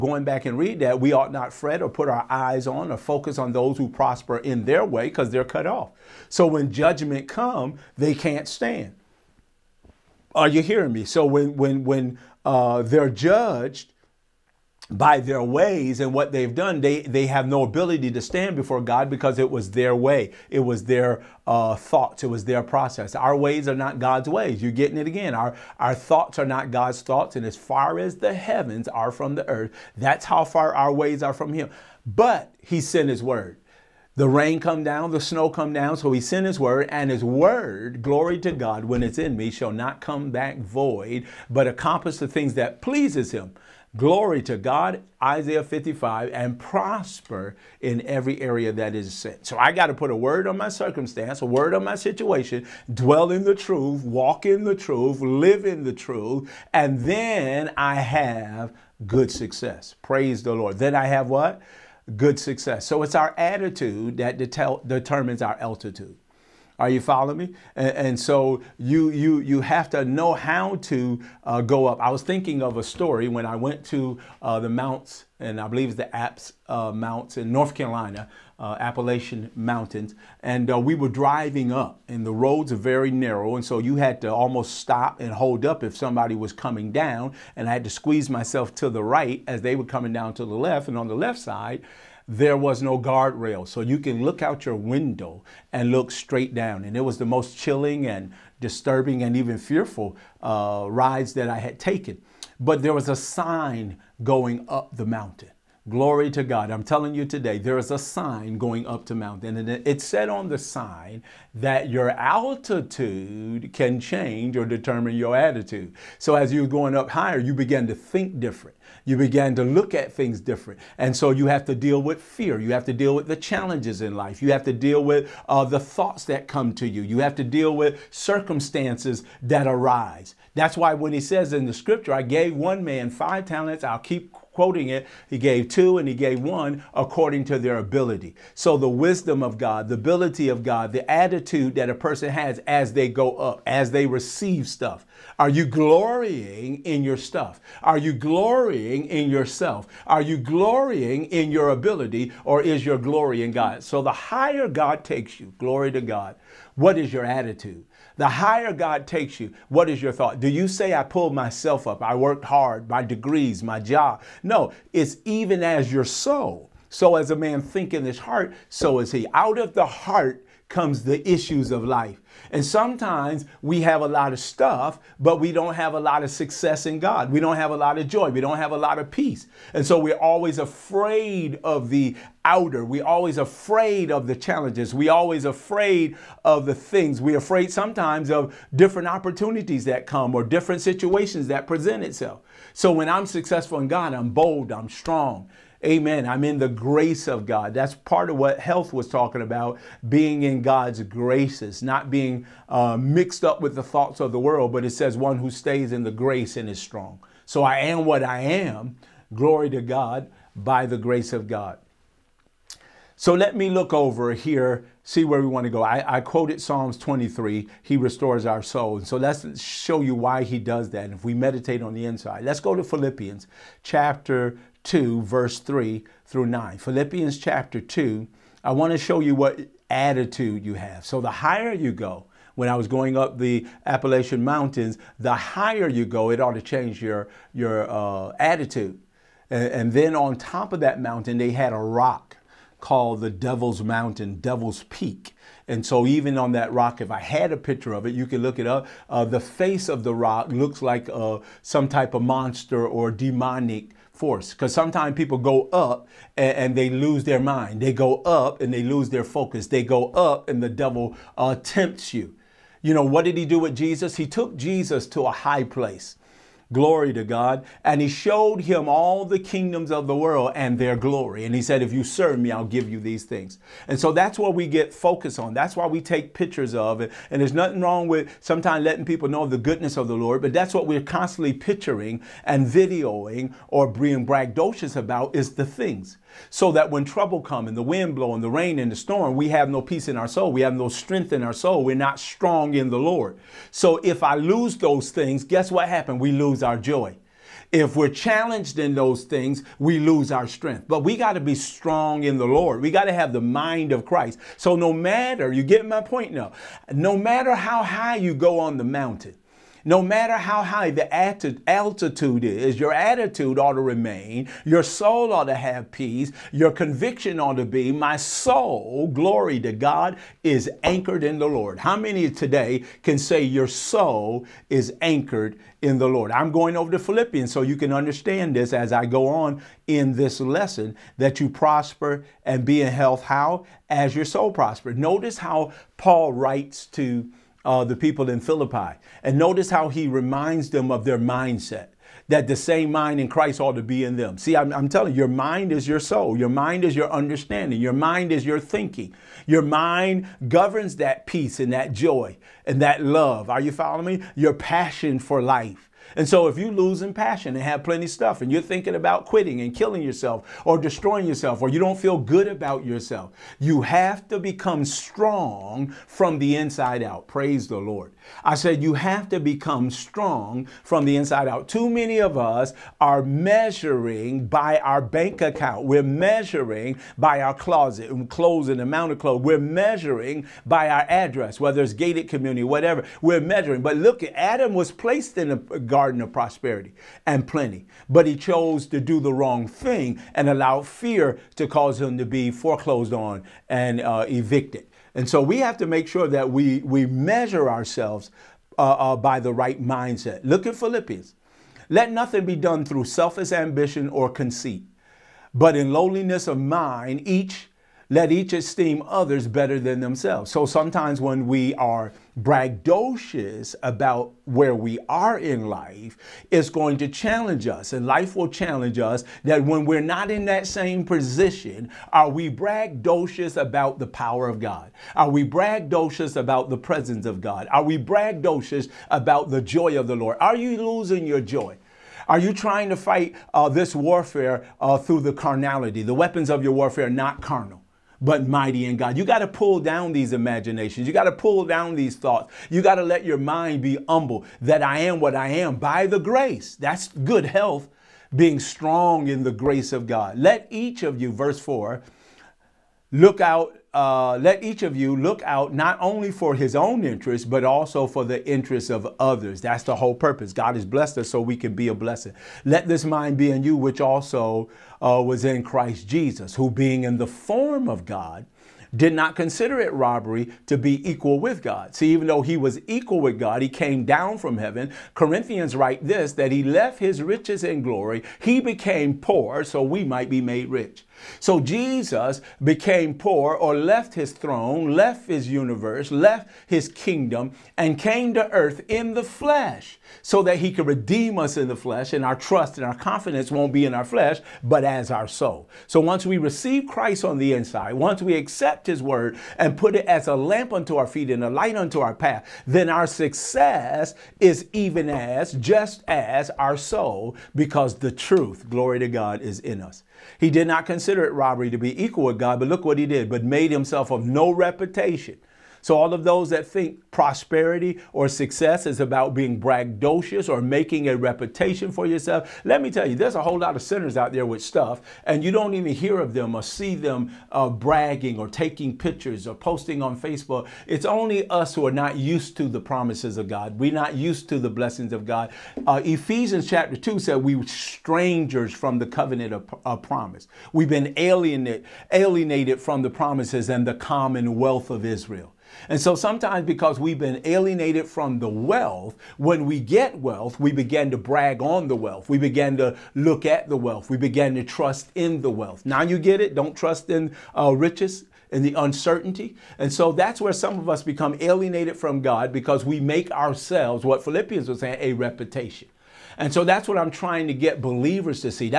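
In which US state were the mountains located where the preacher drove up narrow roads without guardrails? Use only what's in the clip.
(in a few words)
North Carolina.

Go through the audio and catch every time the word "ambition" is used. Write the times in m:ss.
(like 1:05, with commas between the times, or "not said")
6:43.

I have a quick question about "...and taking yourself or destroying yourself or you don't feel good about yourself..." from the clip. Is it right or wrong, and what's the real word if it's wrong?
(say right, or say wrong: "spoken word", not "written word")
wrong: "killing", not "taking".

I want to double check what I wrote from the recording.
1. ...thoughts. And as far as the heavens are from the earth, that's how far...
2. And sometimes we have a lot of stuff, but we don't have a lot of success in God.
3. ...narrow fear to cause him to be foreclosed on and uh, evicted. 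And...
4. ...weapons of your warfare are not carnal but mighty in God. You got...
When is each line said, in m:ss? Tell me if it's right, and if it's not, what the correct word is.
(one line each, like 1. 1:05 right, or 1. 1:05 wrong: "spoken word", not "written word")
1. 0:27 right
2. 2:52 right
3. 6:30 wrong: "allow", not "narrow"
4. 7:16 right.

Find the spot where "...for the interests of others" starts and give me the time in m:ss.
7:38.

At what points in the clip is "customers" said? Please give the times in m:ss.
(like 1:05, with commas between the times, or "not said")
not said.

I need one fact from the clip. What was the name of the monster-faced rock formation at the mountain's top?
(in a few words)
Devil's Peak.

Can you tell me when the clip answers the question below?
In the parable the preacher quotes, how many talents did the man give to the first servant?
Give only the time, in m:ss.
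2:13.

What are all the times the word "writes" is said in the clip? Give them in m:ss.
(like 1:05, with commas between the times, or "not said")
5:36, 7:55.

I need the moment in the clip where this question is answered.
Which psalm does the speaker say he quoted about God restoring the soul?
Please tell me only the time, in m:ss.
3:36.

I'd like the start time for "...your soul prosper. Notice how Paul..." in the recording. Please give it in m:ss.
5:34.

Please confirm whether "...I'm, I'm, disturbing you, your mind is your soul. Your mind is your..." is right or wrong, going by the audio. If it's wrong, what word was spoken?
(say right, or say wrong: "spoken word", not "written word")
wrong: "telling", not "disturbing".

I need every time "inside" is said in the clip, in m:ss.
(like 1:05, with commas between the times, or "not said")
3:42, 6:06, 6:11, 8:17.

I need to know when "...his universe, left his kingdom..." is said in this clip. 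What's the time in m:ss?
8:05.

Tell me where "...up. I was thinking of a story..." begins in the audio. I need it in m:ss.
1:11.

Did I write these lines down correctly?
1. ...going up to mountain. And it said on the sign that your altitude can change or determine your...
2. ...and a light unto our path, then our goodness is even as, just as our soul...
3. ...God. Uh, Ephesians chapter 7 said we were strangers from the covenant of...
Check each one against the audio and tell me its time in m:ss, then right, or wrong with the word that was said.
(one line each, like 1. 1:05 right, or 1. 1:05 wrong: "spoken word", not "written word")
1. 1:48 right
2. 8:21 wrong: "success", not "goodness"
3. 8:55 wrong: "2", not "7".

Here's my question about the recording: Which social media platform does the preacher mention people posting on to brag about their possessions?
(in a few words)
Facebook.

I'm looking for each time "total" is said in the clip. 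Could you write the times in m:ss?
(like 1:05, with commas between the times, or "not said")
not said.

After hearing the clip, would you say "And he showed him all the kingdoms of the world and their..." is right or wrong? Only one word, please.
right.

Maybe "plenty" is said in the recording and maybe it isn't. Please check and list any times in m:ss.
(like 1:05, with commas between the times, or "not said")
5:57, 6:27.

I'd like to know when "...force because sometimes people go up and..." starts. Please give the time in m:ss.
4:14.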